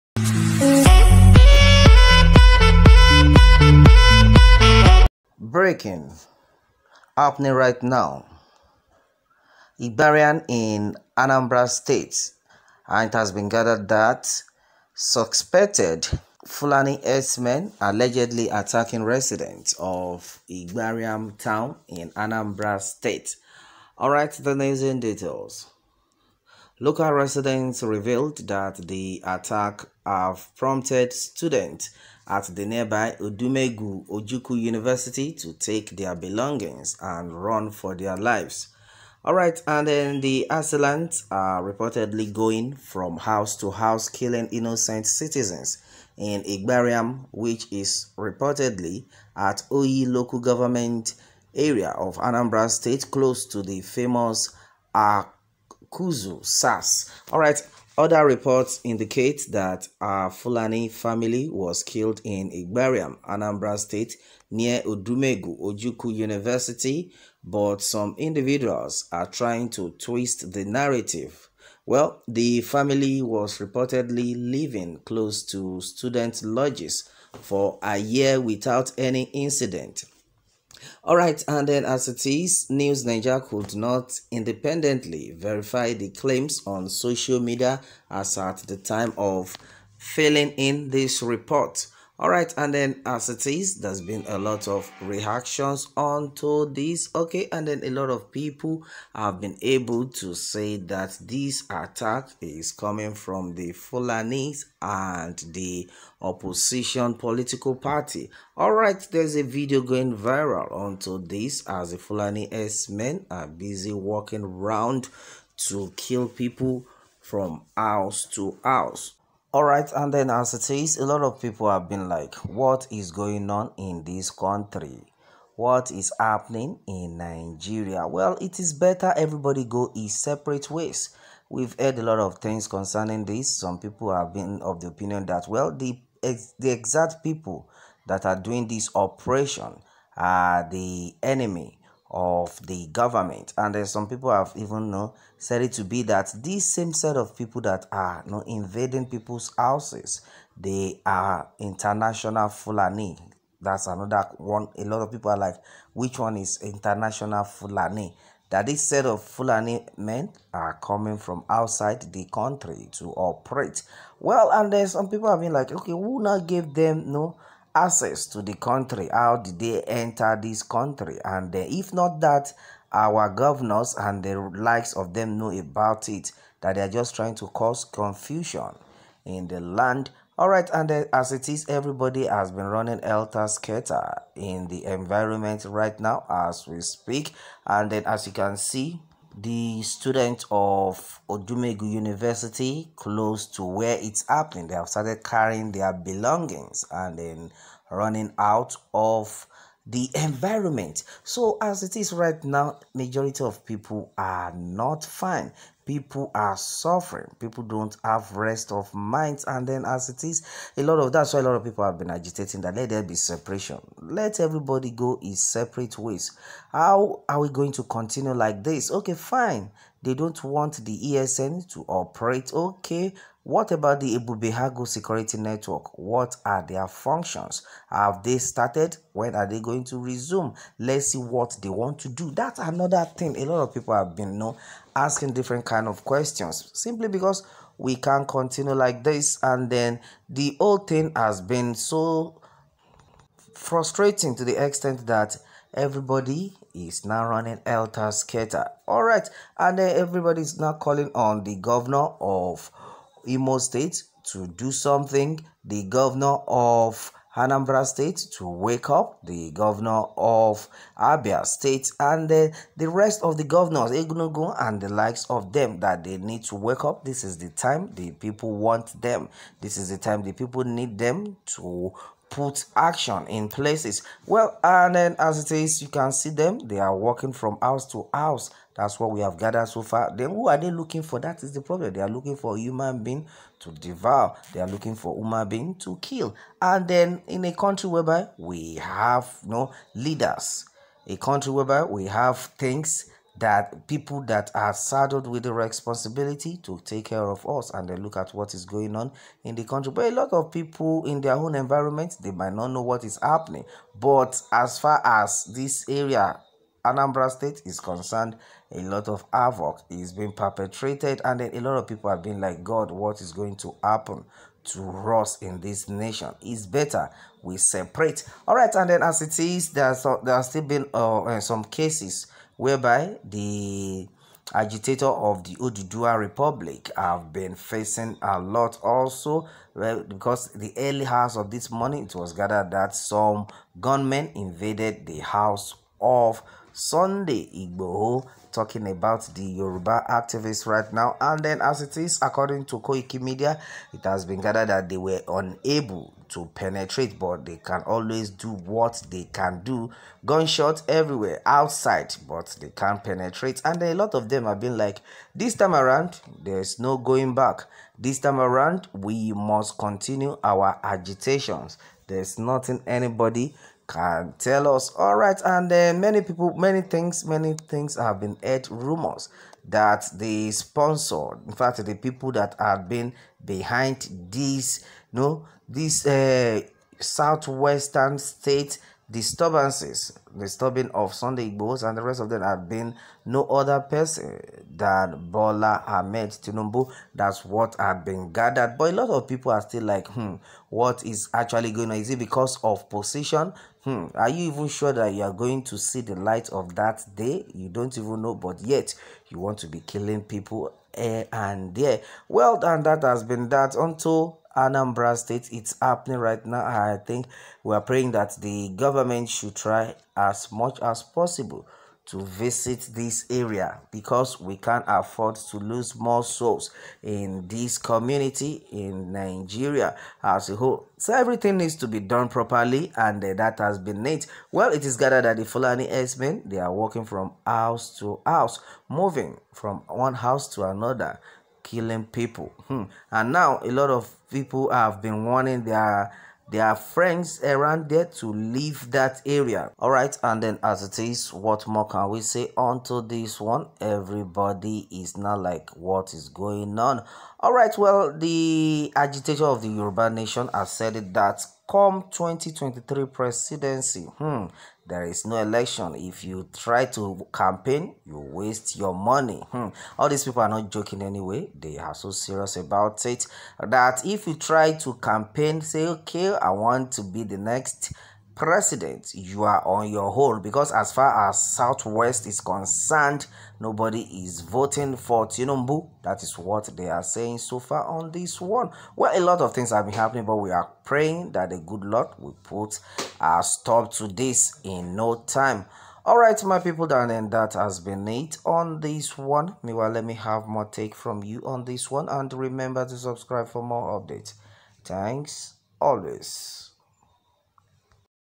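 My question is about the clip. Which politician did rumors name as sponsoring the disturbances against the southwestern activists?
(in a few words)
Bola Ahmed Tinubu.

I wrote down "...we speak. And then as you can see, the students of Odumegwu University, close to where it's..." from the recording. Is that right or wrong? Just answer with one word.
right.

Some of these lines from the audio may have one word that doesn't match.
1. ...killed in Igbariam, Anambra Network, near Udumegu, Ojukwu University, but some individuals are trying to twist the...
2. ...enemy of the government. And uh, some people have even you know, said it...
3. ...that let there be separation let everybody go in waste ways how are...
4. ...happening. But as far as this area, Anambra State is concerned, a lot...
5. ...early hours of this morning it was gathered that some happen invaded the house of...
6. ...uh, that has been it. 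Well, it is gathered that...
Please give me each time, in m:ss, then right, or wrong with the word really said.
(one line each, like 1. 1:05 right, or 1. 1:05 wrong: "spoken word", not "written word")
1. 1:01 wrong: "State", not "Network"
2. 2:21 right
3. 3:32 wrong: "separate", not "waste"
4. 5:03 right
5. 5:30 wrong: "gunmen", not "happen"
6. 7:03 right.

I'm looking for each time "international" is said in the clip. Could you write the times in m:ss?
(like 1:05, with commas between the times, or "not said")
2:31, 2:36.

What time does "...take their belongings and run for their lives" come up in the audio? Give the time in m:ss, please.
0:35.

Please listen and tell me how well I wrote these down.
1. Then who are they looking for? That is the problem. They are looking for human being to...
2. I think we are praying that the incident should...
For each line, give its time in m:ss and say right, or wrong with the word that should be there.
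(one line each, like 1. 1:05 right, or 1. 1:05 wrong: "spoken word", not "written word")
1. 4:40 right
2. 6:46 wrong: "government", not "incident".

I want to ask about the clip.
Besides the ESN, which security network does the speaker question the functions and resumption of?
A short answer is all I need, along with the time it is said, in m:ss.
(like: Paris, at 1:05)
Ebube Agu Security Network, at 3:44.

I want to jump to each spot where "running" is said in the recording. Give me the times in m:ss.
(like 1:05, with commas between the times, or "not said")
3:02, 3:17, 4:07.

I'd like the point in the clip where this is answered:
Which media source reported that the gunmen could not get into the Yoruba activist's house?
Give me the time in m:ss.
5:42.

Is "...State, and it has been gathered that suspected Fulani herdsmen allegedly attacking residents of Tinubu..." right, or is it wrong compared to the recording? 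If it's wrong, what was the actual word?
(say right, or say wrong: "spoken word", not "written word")
wrong: "Igbariam", not "Tinubu".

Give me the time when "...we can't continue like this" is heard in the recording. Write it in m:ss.
3:57.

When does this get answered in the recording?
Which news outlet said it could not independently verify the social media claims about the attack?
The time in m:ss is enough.
1:22.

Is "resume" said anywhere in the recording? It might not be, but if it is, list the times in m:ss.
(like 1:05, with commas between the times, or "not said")
3:49.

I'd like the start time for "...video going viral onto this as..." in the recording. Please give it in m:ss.
1:49.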